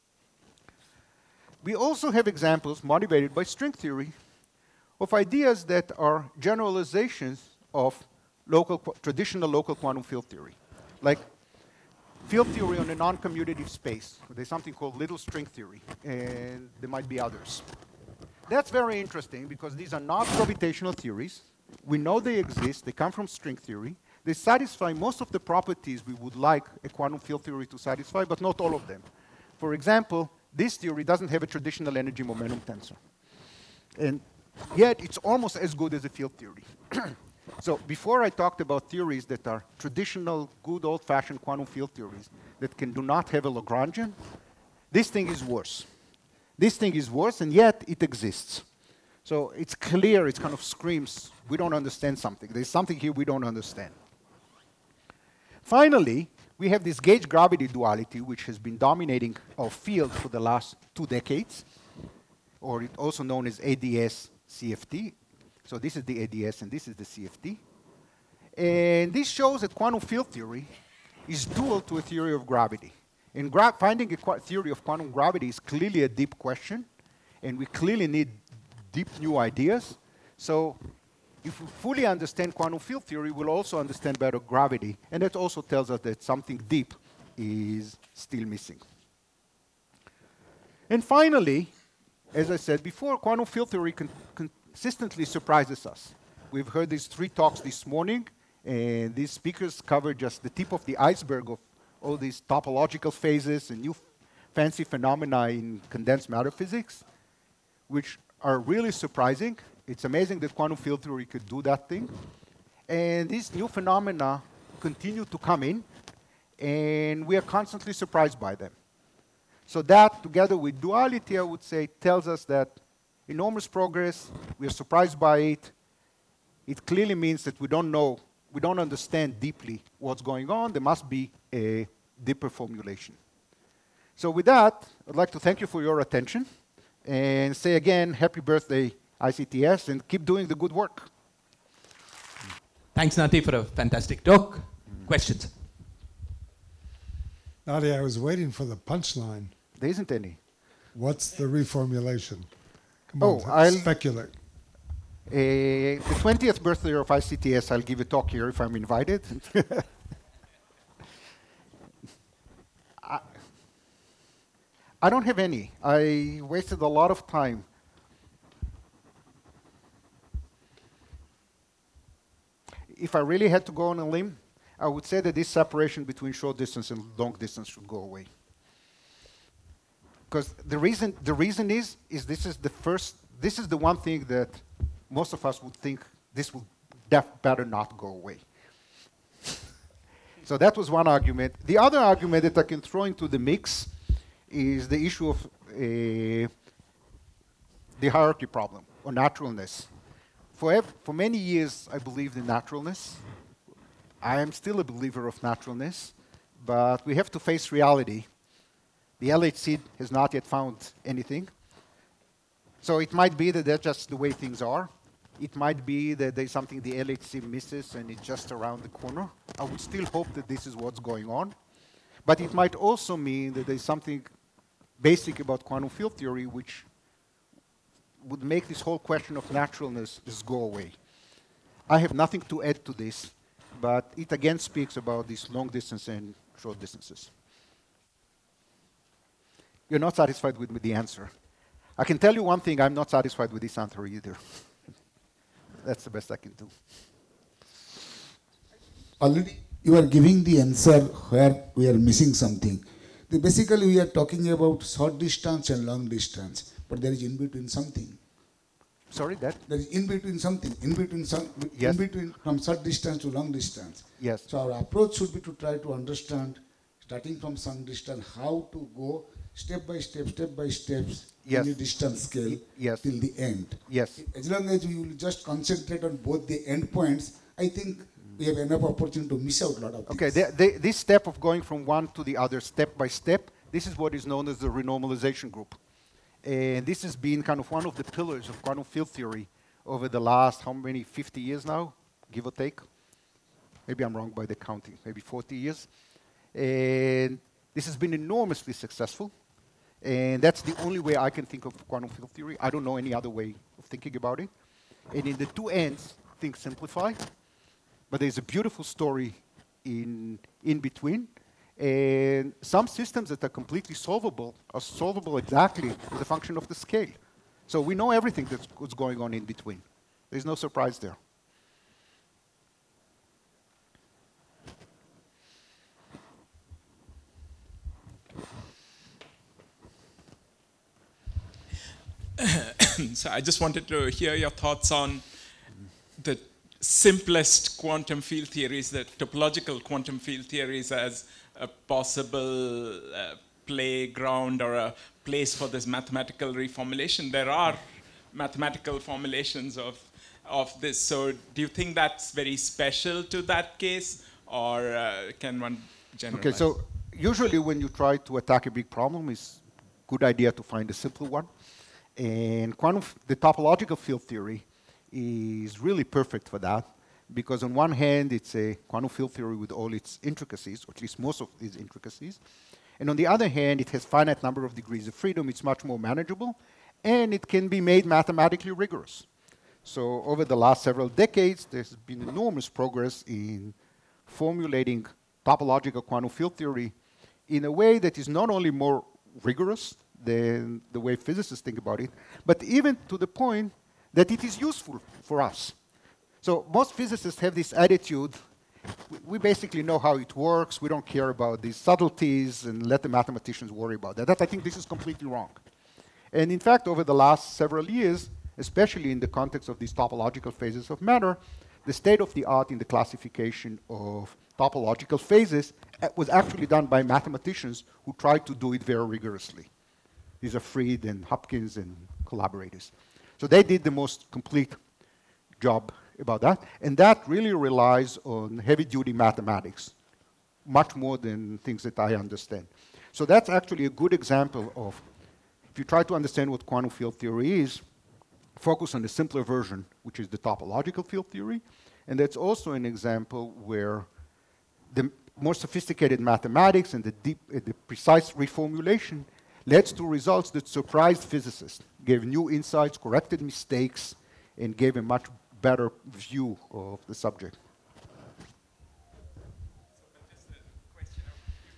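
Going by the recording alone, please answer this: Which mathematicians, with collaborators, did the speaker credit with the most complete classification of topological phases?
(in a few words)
Freed and Hopkins.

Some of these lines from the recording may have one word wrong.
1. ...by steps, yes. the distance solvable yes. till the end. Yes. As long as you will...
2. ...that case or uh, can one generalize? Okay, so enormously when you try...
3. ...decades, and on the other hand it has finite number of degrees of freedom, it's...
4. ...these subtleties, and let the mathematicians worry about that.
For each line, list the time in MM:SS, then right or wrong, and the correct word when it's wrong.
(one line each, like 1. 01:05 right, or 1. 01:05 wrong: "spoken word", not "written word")
1. 04:30 wrong: "scale", not "solvable"
2. 05:53 wrong: "usually", not "enormously"
3. 06:11 wrong: "intricacies", not "decades"
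4. 06:41 right.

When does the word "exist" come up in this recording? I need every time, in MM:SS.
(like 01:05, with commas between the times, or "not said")
00:22, 00:48.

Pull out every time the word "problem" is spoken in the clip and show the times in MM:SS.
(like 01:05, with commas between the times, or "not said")
03:18, 05:58.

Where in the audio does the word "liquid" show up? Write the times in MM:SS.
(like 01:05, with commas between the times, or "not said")
not said.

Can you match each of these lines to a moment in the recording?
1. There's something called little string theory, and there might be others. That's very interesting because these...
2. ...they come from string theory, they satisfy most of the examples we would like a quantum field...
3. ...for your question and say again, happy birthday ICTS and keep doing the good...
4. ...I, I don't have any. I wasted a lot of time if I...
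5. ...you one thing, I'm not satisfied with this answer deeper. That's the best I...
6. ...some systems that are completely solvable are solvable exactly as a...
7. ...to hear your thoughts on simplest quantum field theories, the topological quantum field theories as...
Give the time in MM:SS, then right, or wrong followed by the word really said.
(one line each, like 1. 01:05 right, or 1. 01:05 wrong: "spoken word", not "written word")
1. 00:14 right
2. 00:22 wrong: "properties", not "examples"
3. 02:15 wrong: "attention", not "question"
4. 02:43 right
5. 04:02 wrong: "either", not "deeper"
6. 05:12 right
7. 05:33 right.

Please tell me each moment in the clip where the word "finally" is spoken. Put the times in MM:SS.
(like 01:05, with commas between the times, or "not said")
00:55, 01:31.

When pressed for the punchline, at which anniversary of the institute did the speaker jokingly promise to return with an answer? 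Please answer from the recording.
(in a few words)
20th.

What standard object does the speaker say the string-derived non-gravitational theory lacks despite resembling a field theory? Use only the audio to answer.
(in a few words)
energy momentum tensor.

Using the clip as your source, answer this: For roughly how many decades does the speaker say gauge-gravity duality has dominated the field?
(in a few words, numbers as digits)
2.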